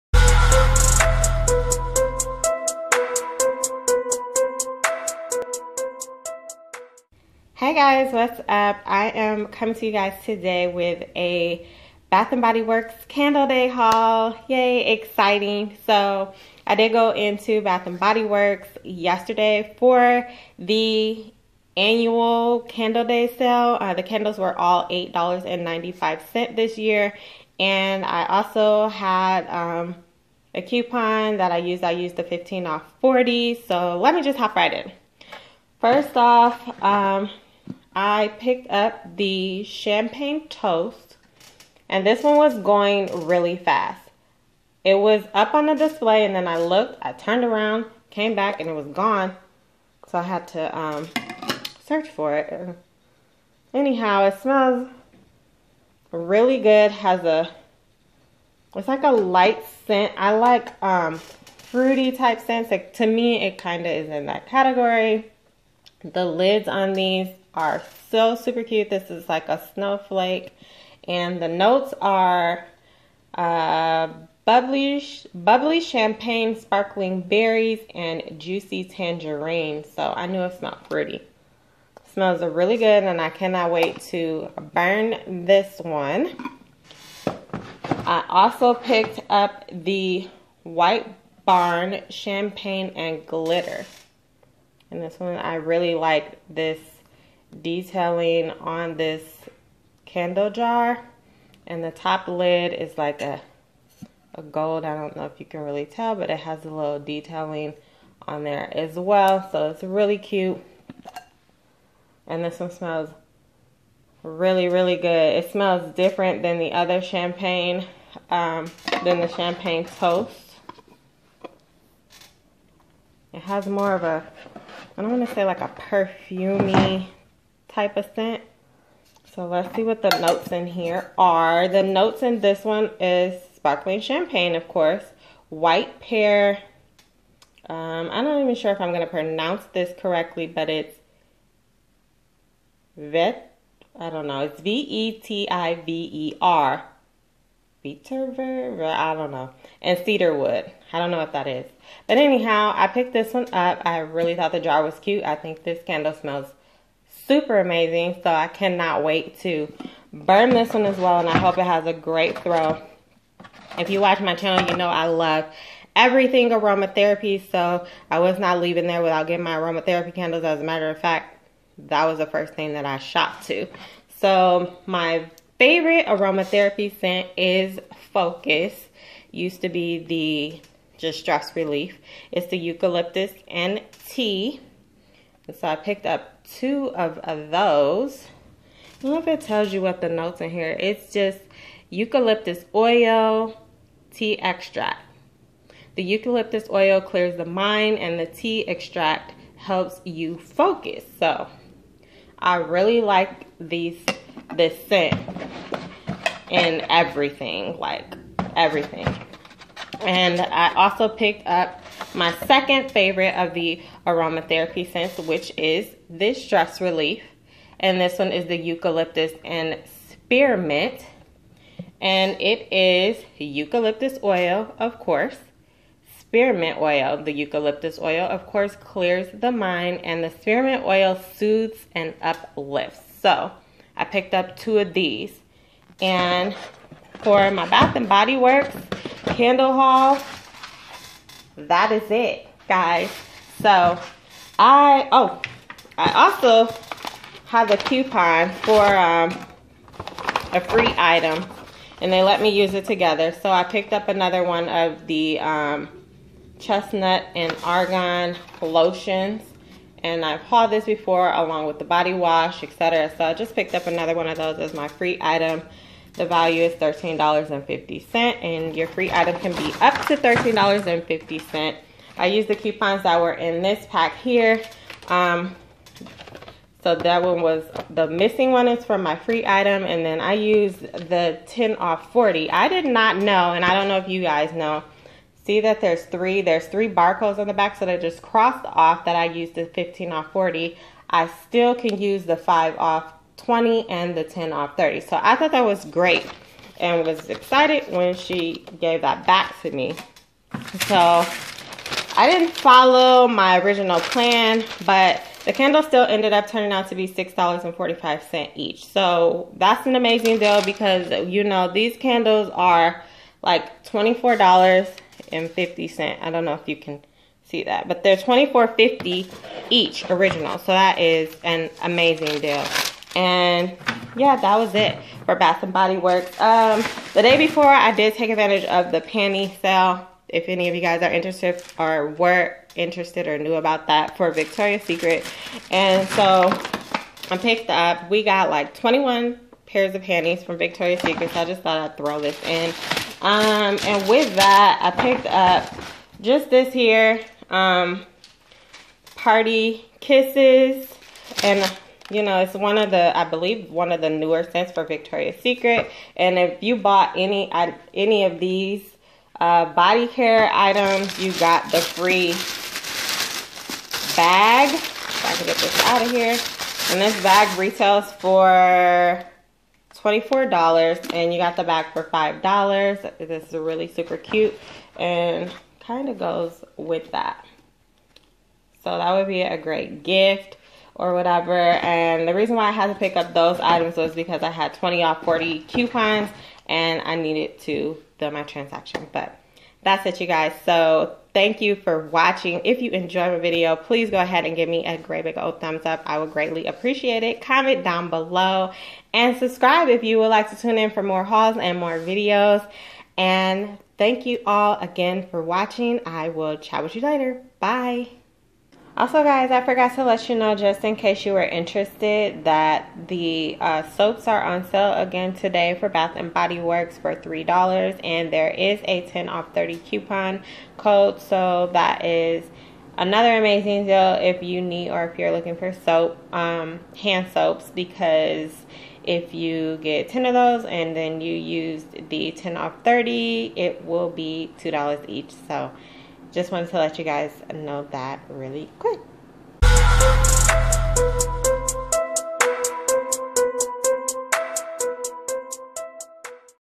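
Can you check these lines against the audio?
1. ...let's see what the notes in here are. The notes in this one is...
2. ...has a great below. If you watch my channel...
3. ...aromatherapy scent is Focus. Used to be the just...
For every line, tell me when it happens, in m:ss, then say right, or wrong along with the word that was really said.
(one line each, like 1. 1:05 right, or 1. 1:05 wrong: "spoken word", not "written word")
1. 2:09 right
2. 2:41 wrong: "throw", not "below"
3. 2:56 right.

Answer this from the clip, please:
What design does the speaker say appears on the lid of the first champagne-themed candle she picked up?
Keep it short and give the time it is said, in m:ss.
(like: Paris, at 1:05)
snowflake, at 1:09.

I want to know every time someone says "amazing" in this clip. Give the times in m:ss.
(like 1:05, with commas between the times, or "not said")
2:37, 5:09, 5:21, 7:03.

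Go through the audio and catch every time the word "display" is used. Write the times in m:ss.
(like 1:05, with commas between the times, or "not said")
0:45.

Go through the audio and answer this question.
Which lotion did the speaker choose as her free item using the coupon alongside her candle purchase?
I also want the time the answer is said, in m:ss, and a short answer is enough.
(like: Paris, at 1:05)
chestnut and argan, at 4:16.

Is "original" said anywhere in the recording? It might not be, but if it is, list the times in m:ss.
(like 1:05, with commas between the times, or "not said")
5:03, 5:20.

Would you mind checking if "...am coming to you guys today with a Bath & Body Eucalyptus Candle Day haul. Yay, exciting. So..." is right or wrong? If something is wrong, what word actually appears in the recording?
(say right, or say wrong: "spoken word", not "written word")
wrong: "Works", not "Eucalyptus".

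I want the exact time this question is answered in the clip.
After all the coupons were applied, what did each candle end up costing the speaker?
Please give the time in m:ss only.
5:07.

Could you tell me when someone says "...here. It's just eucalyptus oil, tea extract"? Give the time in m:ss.
3:10.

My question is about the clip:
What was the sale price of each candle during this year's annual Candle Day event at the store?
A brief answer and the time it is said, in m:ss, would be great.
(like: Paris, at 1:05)
$8.95, at 0:24.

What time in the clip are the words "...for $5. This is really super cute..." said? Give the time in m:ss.
6:11.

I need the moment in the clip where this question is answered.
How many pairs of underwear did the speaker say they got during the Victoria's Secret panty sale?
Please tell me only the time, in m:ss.
5:38.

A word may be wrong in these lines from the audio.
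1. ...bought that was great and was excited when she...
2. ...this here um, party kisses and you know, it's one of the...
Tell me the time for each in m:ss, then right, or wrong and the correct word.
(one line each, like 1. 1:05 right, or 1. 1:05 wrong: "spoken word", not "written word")
1. 4:55 wrong: "thought", not "bought"
2. 5:46 right.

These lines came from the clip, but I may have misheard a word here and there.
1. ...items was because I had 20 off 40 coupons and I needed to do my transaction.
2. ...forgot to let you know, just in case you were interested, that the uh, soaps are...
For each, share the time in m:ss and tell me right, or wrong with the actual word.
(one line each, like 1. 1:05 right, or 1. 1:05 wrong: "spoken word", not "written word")
1. 6:23 right
2. 6:49 right.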